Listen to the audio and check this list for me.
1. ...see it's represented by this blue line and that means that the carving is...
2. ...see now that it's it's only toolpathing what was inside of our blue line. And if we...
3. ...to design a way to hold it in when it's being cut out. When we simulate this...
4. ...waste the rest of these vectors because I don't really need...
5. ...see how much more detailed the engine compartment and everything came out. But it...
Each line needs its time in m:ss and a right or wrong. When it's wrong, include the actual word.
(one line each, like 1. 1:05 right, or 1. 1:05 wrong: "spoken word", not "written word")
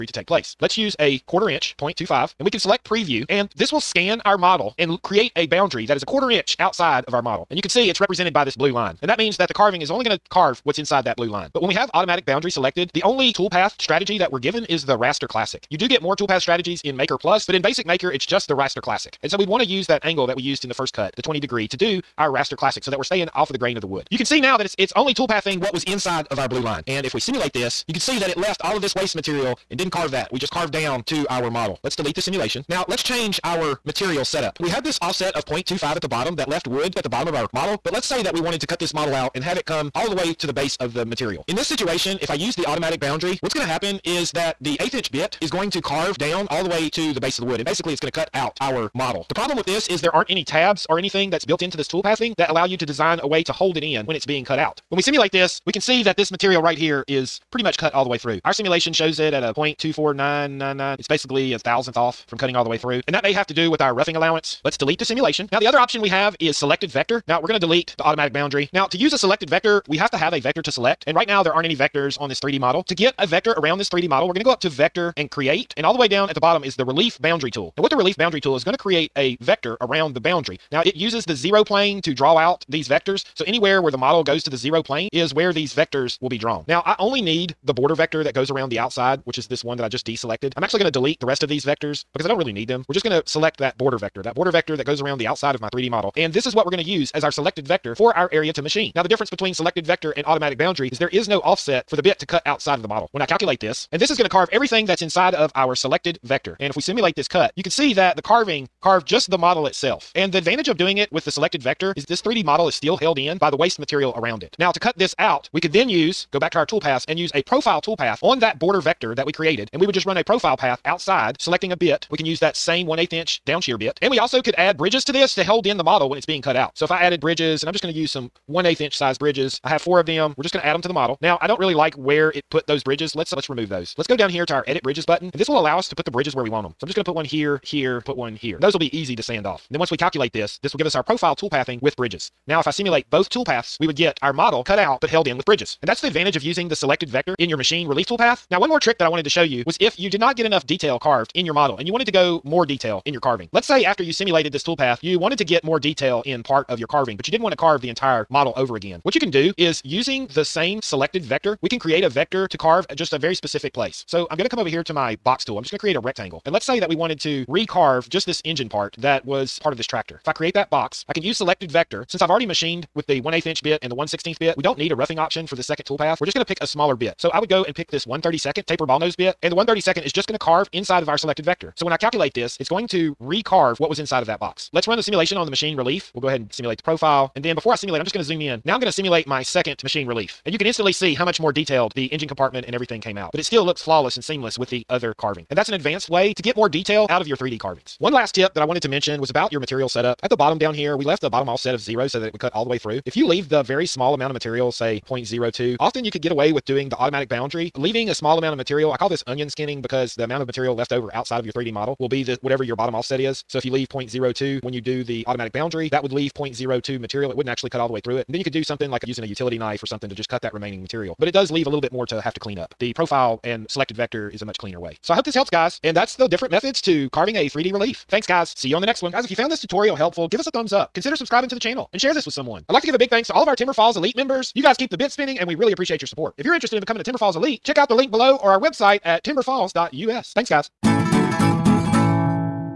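1. 0:07 right
2. 0:24 right
3. 0:52 right
4. 1:30 wrong: "delete", not "waste"
5. 3:10 right.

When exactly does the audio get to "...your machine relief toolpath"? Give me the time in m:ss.
2:27.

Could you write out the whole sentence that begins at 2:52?
Since I've already machined with the 1 8 inch bit and the 1 16th bit.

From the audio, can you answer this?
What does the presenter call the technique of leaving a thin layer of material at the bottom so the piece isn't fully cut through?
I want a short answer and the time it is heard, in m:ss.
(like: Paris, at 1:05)
Onion skinning, at 3:29.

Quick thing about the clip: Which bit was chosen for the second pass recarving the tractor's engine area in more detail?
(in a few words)
1/32 taper ball nose.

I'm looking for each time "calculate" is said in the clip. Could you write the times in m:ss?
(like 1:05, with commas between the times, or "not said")
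1:43, 2:19, 3:01.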